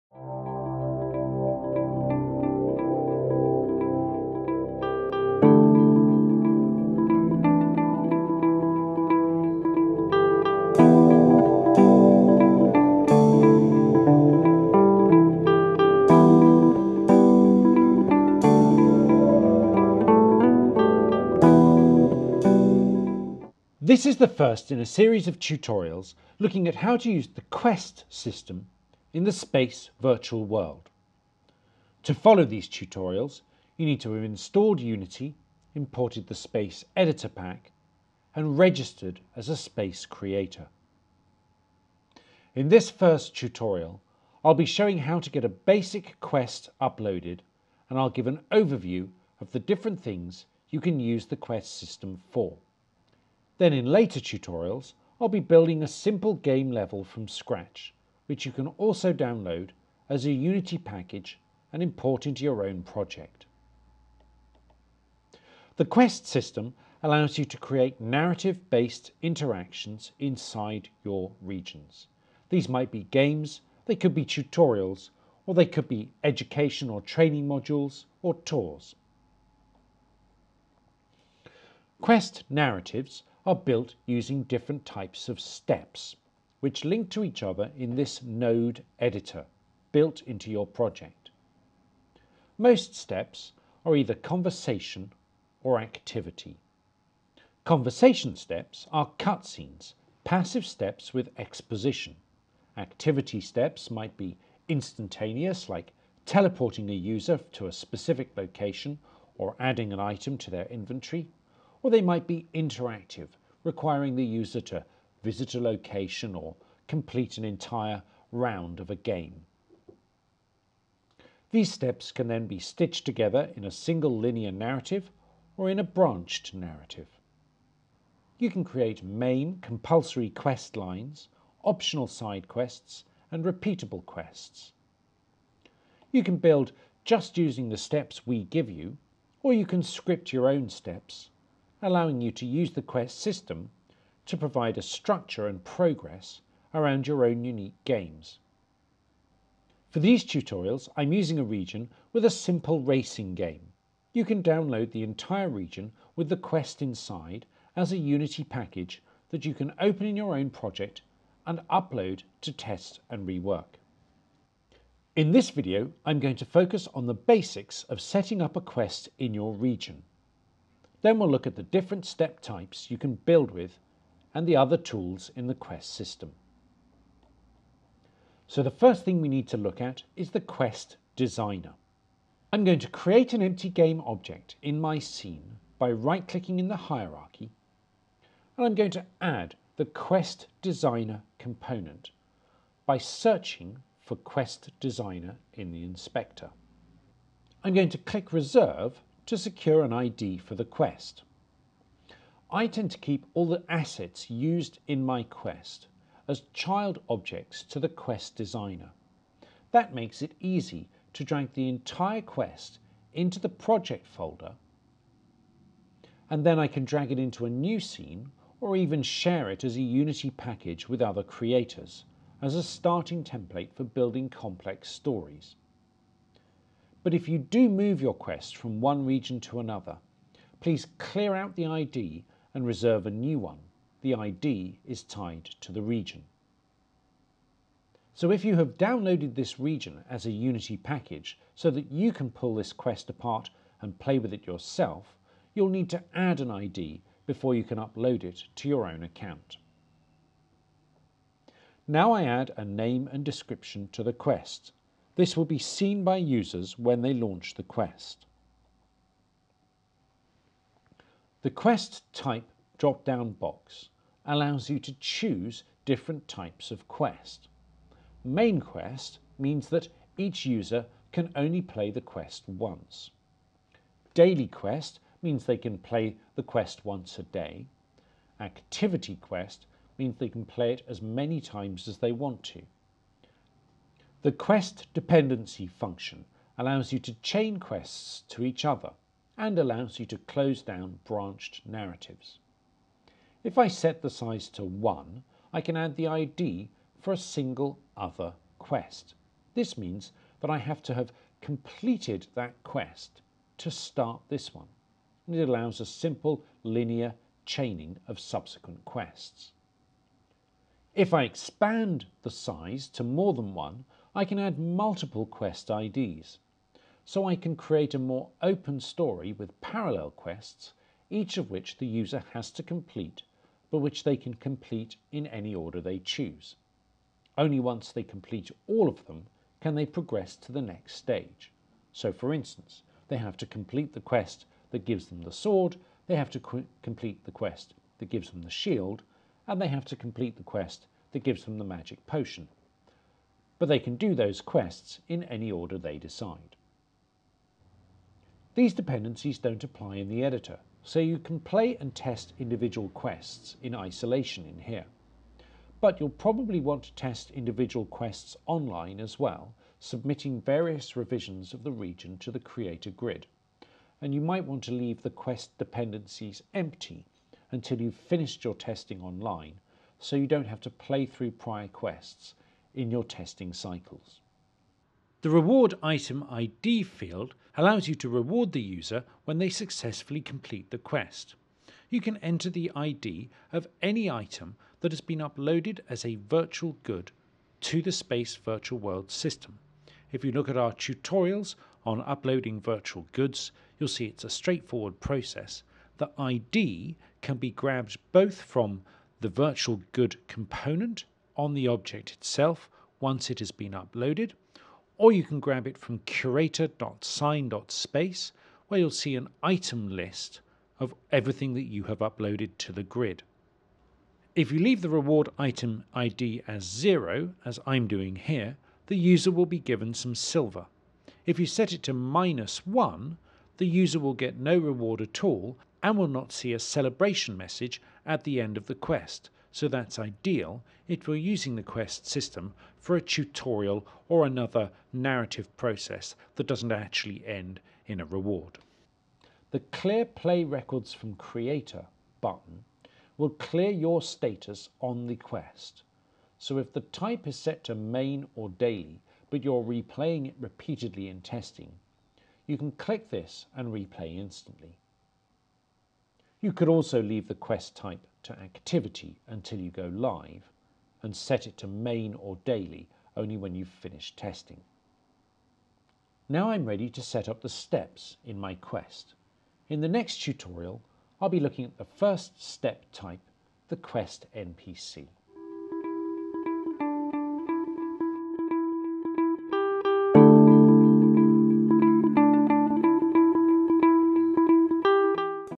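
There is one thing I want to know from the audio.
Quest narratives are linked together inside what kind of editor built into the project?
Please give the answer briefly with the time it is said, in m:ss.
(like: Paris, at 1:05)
node editor, at 1:28.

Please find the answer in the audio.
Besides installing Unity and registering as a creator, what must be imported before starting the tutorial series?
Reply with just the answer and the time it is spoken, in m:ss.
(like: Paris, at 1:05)
Space Editor Pack, at 0:36.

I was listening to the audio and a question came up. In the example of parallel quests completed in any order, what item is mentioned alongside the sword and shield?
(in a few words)
magic potion.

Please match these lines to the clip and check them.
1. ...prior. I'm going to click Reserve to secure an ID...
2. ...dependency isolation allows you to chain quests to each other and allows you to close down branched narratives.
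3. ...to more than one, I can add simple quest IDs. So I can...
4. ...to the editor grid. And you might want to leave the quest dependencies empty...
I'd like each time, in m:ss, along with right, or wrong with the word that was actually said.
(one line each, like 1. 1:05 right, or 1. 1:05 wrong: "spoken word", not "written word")
1. 3:15 wrong: "inspector", not "prior"
2. 4:44 wrong: "function", not "isolation"
3. 5:12 wrong: "multiple", not "simple"
4. 6:02 wrong: "creator", not "editor".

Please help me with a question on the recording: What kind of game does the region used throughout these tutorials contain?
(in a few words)
racing game.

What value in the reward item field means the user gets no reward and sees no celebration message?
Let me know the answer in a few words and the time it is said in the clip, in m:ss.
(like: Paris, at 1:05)
-1, at 7:01.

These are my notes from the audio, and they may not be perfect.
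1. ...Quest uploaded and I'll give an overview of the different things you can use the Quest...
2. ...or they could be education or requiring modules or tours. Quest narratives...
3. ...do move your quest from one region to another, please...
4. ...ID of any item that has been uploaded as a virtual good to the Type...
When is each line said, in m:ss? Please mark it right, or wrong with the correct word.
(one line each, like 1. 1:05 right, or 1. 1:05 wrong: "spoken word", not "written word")
1. 0:46 right
2. 1:15 wrong: "training", not "requiring"
3. 3:47 right
4. 6:22 wrong: "Space", not "Type".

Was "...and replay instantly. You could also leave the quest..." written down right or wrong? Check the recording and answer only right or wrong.
right.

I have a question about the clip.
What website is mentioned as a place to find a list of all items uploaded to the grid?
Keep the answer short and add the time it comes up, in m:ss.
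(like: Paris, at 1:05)
curator.sine.space, at 6:45.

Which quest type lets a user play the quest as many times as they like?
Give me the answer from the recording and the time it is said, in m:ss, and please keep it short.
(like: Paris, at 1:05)
Activity quest, at 4:38.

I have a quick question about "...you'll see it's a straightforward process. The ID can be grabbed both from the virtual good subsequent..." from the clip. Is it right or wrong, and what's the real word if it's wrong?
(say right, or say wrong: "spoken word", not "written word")
wrong: "component", not "subsequent".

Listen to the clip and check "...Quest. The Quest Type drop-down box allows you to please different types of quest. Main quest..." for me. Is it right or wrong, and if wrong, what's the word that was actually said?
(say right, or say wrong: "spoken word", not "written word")
wrong: "choose", not "please".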